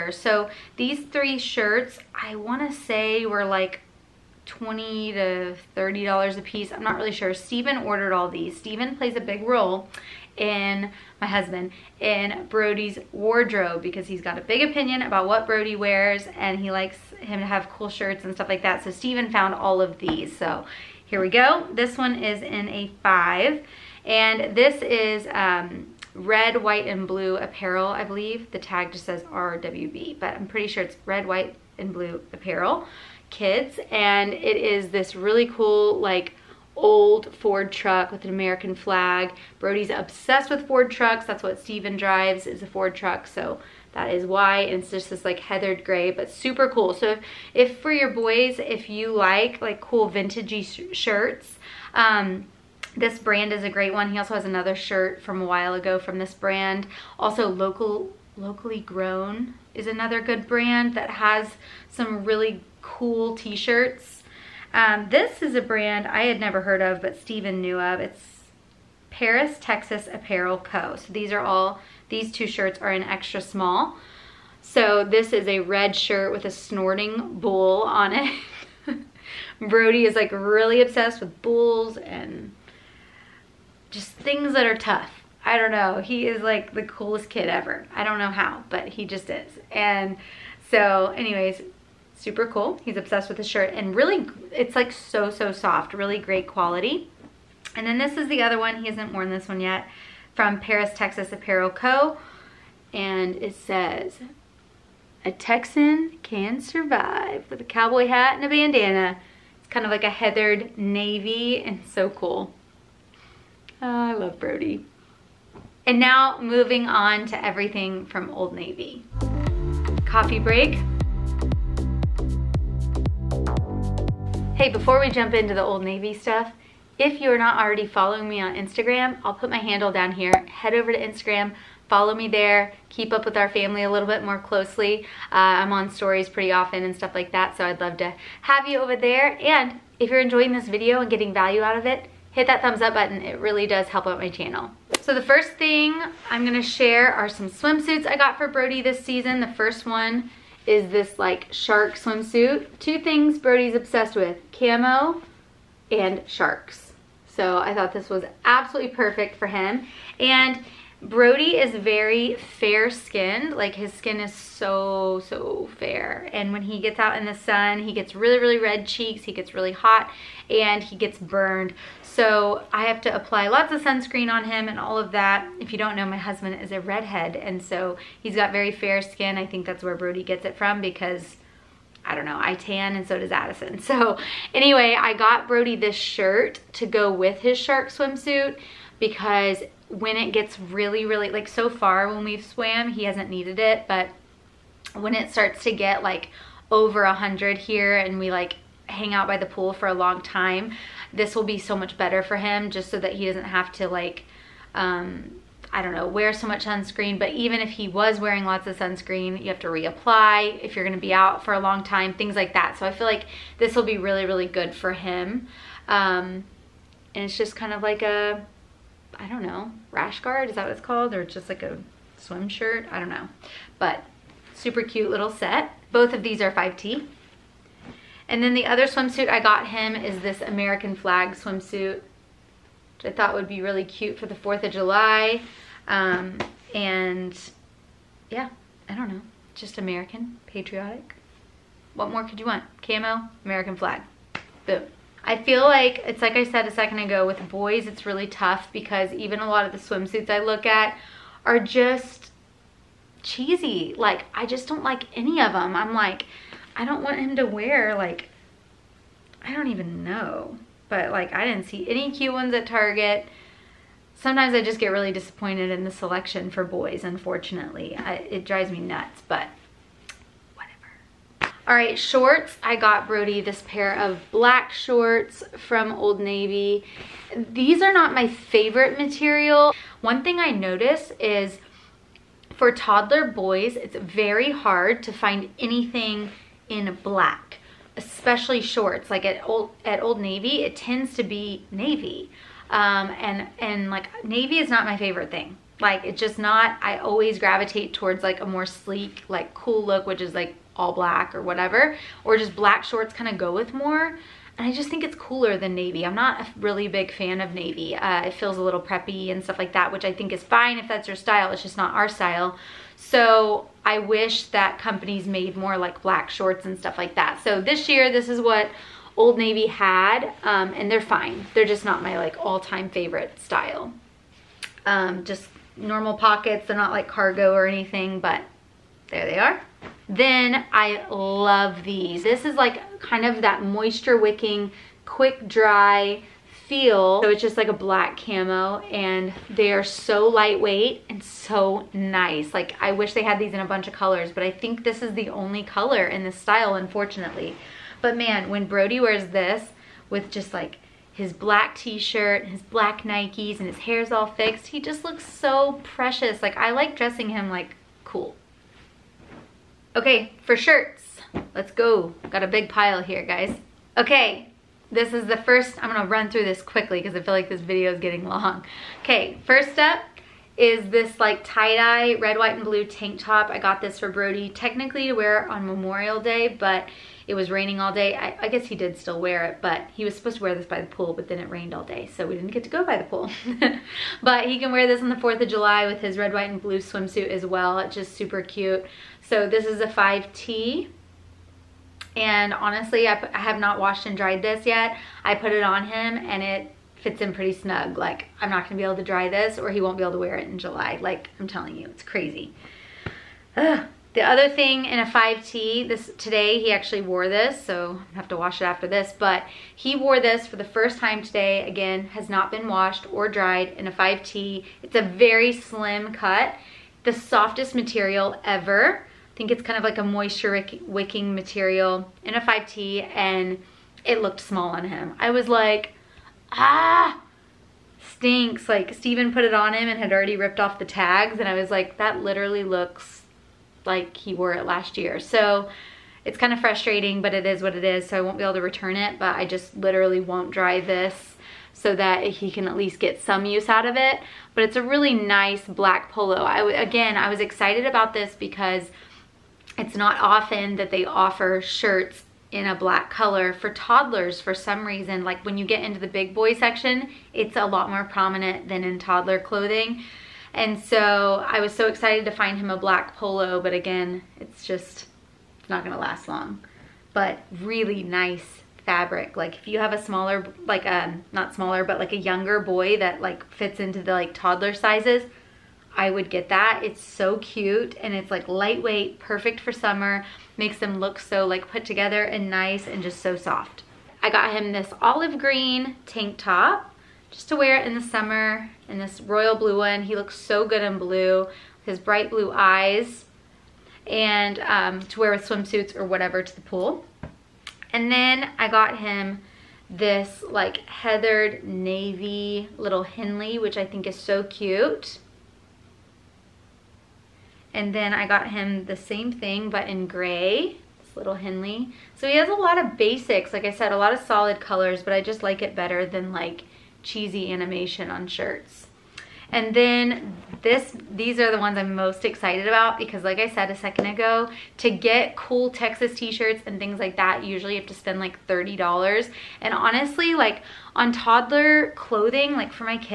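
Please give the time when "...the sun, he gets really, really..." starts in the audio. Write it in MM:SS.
02:47.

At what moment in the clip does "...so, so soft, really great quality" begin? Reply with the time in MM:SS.
01:34.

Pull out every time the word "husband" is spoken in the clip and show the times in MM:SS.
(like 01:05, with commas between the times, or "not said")
00:11, 02:56.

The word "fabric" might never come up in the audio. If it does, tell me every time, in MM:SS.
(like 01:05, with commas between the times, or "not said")
07:48.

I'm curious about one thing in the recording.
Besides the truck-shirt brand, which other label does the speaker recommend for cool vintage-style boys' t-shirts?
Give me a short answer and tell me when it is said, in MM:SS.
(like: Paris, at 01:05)
Locally Grown, at 00:58.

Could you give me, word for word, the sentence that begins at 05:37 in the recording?
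So it's just like a black camo and they are so lightweight and so nice.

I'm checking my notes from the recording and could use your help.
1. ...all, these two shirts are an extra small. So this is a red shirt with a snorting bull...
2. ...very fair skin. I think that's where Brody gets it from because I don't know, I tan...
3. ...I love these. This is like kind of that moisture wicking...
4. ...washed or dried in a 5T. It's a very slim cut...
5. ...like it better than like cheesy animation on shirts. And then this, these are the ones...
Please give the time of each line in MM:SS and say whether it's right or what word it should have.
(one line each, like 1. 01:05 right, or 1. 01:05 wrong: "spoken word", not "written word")
1. 01:11 right
2. 02:58 right
3. 05:30 right
4. 06:52 right
5. 08:35 right.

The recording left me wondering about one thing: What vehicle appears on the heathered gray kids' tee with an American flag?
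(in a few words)
Old Ford truck.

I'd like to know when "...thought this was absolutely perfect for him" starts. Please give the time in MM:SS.
02:37.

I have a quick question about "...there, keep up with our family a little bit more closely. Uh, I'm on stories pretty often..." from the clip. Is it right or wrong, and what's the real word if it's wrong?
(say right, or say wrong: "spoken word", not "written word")
right.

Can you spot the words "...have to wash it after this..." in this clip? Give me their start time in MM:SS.
06:48.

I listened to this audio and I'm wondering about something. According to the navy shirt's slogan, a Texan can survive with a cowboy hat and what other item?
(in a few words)
A bandana.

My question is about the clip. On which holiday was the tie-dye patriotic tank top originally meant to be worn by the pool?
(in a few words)
Memorial Day.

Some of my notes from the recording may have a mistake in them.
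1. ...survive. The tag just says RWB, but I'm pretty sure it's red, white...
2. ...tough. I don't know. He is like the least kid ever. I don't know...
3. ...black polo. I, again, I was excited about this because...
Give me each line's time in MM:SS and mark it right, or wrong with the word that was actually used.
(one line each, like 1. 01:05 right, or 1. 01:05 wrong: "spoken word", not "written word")
1. 00:28 wrong: "believe", not "survive"
2. 01:24 wrong: "coolest", not "least"
3. 07:25 right.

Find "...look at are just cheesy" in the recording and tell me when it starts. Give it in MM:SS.
04:10.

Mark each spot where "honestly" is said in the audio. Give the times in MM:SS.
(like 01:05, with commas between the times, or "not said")
06:32, 08:49.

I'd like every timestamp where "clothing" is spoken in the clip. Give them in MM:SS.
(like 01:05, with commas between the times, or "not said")
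07:39, 08:51.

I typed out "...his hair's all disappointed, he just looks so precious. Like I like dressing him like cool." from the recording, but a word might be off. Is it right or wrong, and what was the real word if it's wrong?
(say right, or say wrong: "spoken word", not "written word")
wrong: "fixed", not "disappointed".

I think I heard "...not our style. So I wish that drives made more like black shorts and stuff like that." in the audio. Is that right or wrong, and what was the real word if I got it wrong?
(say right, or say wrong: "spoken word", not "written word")
wrong: "companies", not "drives".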